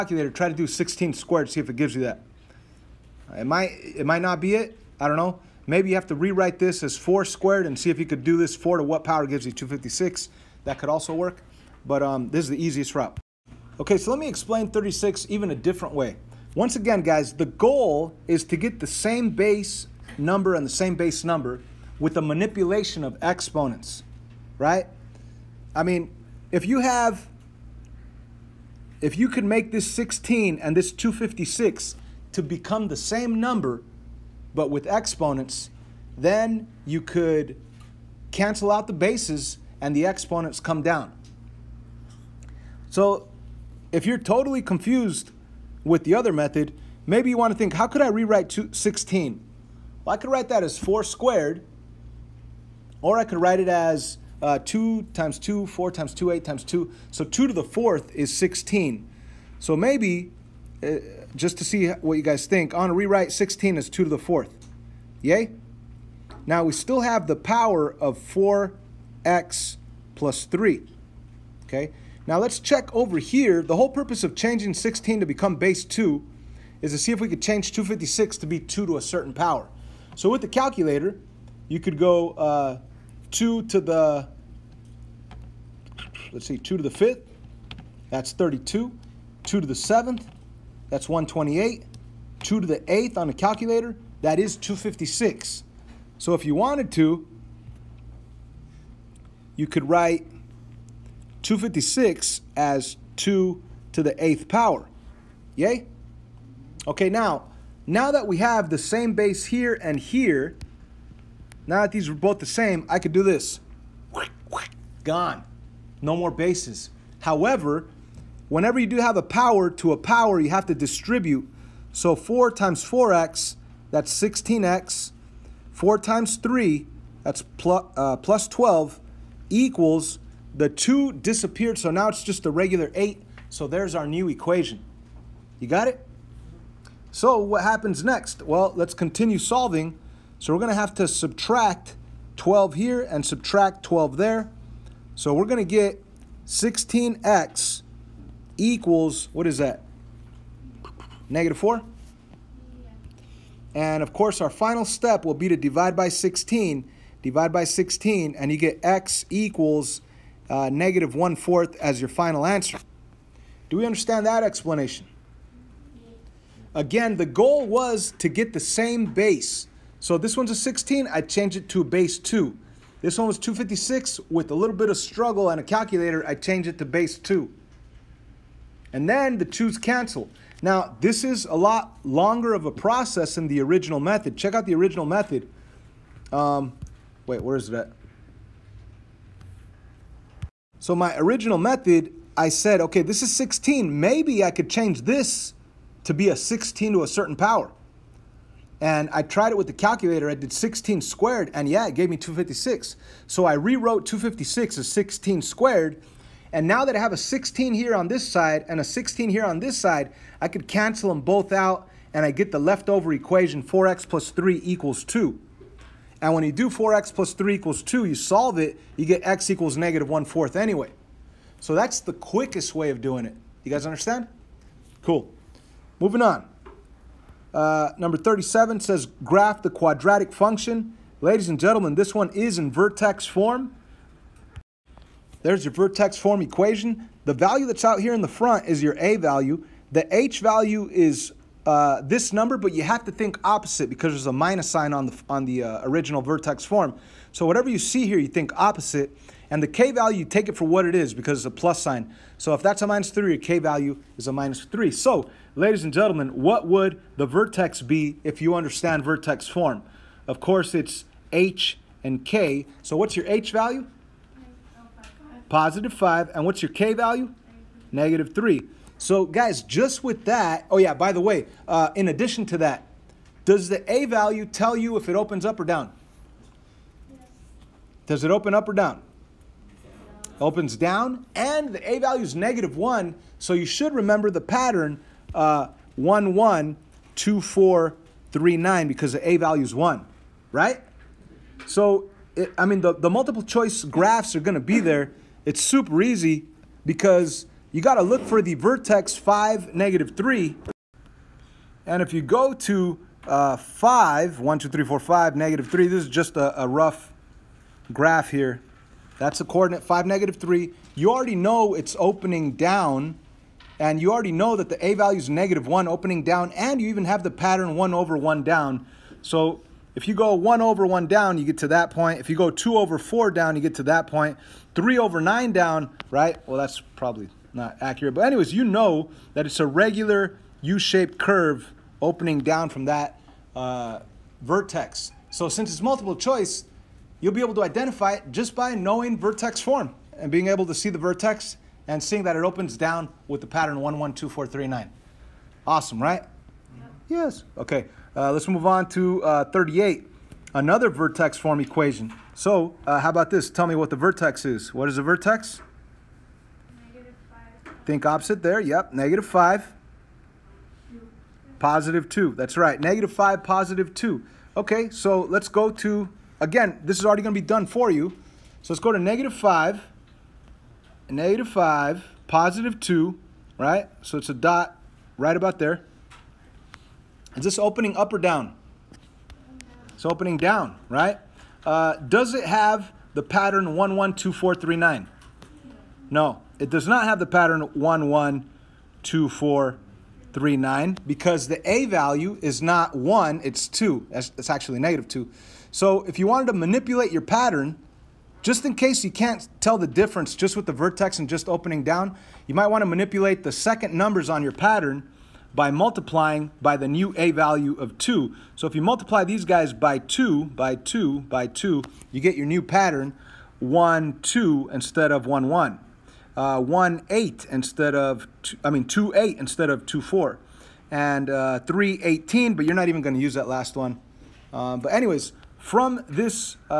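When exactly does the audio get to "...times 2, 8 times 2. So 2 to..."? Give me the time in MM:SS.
00:55.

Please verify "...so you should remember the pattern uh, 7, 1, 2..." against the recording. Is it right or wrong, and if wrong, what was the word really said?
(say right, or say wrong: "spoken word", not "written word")
wrong: "1", not "7".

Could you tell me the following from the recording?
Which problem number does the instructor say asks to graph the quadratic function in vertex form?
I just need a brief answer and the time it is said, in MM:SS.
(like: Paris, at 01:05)
37, at 03:47.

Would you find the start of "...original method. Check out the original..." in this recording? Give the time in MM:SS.
03:03.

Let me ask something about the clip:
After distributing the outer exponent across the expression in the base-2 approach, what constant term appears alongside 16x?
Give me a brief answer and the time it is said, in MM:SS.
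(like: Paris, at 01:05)
12, at 02:08.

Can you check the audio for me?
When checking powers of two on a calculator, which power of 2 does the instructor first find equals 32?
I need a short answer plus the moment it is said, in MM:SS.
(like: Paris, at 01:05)
2 to the 5th, at 01:26.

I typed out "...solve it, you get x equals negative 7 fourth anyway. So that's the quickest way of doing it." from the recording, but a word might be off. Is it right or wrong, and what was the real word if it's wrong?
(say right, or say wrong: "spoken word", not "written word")
wrong: "1", not "7".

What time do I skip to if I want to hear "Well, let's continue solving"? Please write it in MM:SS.
02:18.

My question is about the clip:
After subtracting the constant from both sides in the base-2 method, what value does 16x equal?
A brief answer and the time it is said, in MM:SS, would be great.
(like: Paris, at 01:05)
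-4, at 02:31.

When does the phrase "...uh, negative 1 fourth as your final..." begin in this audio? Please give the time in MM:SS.
02:40.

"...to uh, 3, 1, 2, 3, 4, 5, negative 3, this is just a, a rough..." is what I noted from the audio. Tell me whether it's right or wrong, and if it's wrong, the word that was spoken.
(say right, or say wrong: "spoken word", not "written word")
wrong: "5", not "3".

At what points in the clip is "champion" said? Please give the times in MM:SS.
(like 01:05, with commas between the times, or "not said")
not said.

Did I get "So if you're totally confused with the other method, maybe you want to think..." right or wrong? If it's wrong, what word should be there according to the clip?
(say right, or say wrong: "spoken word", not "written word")
right.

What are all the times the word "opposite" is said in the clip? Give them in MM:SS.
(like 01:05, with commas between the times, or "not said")
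04:03, 04:08, 05:58.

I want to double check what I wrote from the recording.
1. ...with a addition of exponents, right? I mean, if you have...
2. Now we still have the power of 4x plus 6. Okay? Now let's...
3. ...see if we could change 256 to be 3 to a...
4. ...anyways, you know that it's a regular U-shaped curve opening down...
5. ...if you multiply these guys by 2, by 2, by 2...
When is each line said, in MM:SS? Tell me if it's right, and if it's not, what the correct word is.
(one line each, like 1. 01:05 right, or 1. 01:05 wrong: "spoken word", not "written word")
1. 00:21 wrong: "manipulation", not "addition"
2. 01:06 wrong: "3", not "6"
3. 01:16 wrong: "2", not "3"
4. 05:28 right
5. 06:48 right.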